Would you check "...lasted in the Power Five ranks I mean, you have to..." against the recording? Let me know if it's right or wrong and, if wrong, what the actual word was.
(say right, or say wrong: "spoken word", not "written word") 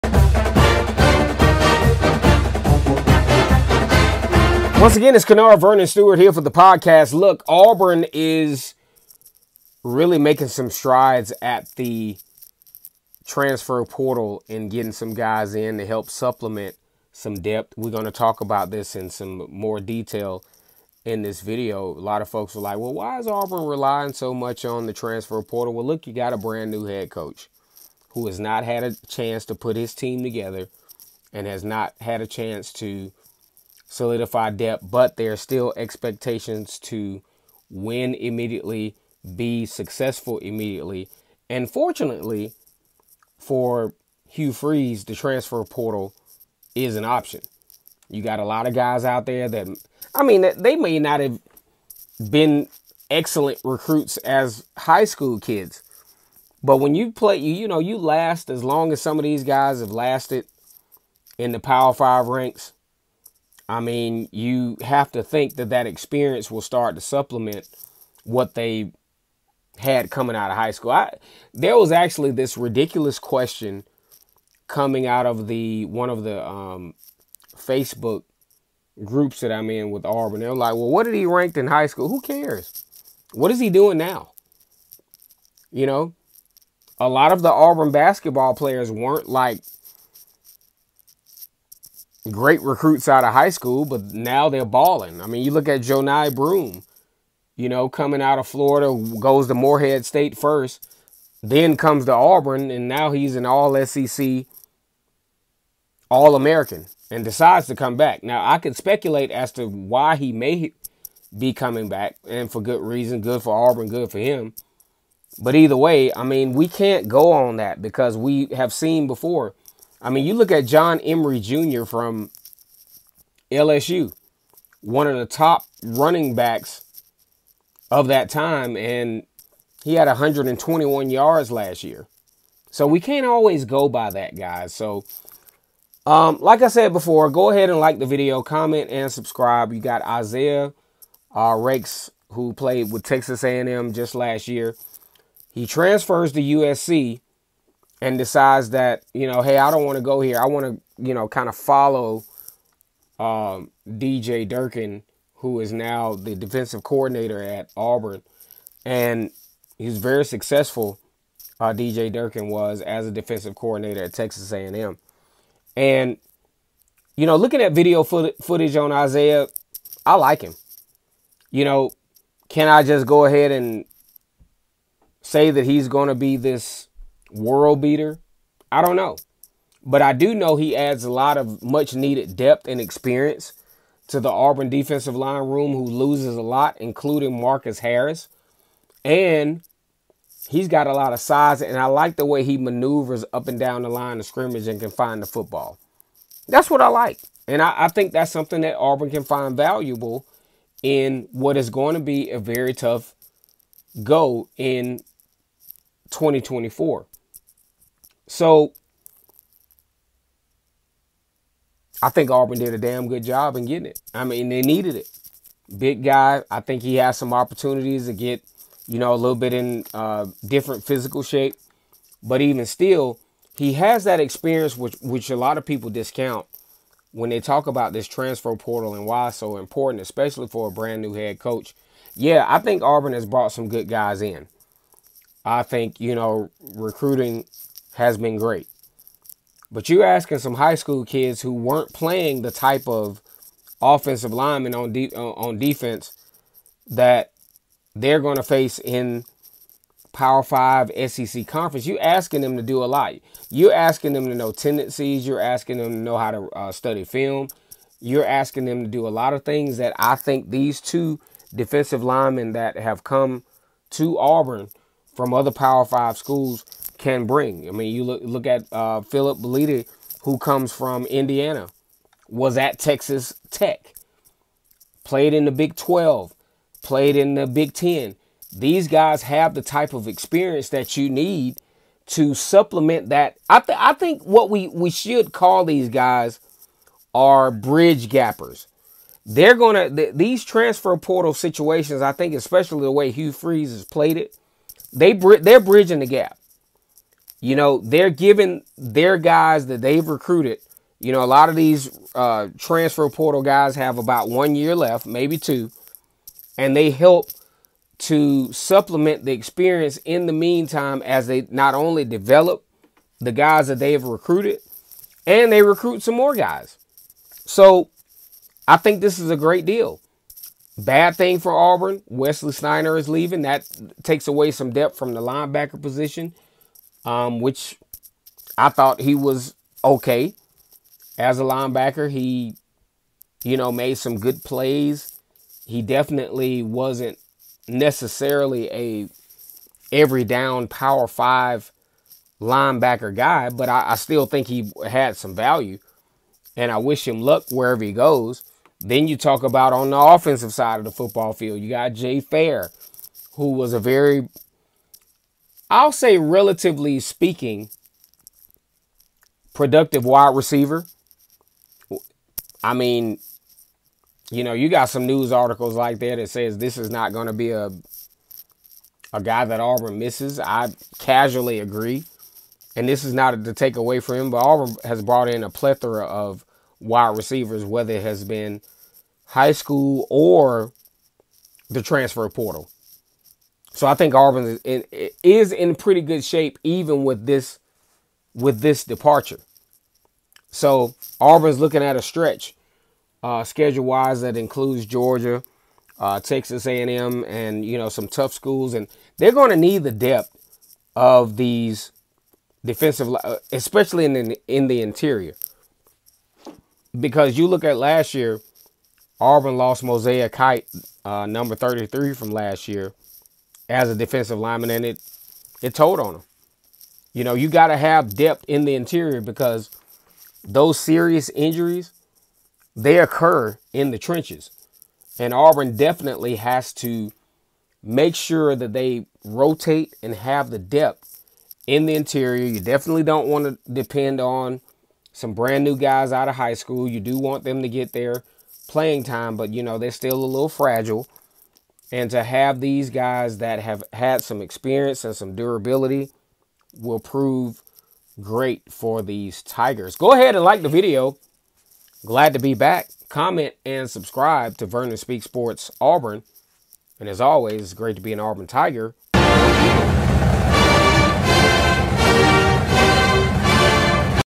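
right.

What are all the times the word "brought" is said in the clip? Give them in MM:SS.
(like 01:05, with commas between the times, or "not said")
03:53, 06:15.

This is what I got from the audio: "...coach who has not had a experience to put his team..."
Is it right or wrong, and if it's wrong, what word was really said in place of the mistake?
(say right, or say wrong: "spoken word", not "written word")
wrong: "chance", not "experience".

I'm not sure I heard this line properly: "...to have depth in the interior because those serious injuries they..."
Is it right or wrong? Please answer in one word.
right.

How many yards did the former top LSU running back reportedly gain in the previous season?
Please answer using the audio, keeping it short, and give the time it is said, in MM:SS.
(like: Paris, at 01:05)
121, at 02:10.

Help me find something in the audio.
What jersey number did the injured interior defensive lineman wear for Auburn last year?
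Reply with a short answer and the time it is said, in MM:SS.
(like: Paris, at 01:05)
33, at 06:51.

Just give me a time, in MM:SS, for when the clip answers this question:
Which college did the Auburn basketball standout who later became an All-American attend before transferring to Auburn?
01:39.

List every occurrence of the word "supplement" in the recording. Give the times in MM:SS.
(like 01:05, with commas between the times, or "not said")
00:16, 01:07, 04:42, 05:08.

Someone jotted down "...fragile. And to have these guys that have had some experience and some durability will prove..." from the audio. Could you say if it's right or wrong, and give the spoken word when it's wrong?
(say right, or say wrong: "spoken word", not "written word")
right.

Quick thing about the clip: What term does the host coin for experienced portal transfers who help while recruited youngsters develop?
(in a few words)
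bridge gappers.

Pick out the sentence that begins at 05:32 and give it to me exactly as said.
He, you know, made some good plays.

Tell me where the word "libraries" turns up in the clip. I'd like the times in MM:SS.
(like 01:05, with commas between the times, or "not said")
not said.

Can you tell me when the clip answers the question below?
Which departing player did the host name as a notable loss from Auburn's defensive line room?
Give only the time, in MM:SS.
03:07.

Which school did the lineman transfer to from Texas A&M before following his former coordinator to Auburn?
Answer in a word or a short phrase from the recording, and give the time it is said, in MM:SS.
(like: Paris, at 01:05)
USC, at 02:26.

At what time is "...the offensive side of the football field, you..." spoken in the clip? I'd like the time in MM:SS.
05:49.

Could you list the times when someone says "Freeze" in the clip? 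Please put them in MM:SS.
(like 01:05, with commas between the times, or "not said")
00:44, 04:53.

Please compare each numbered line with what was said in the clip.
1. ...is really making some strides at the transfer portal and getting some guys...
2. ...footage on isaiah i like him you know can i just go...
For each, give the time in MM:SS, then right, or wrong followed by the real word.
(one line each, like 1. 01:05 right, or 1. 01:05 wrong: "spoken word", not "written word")
1. 00:08 right
2. 02:48 right.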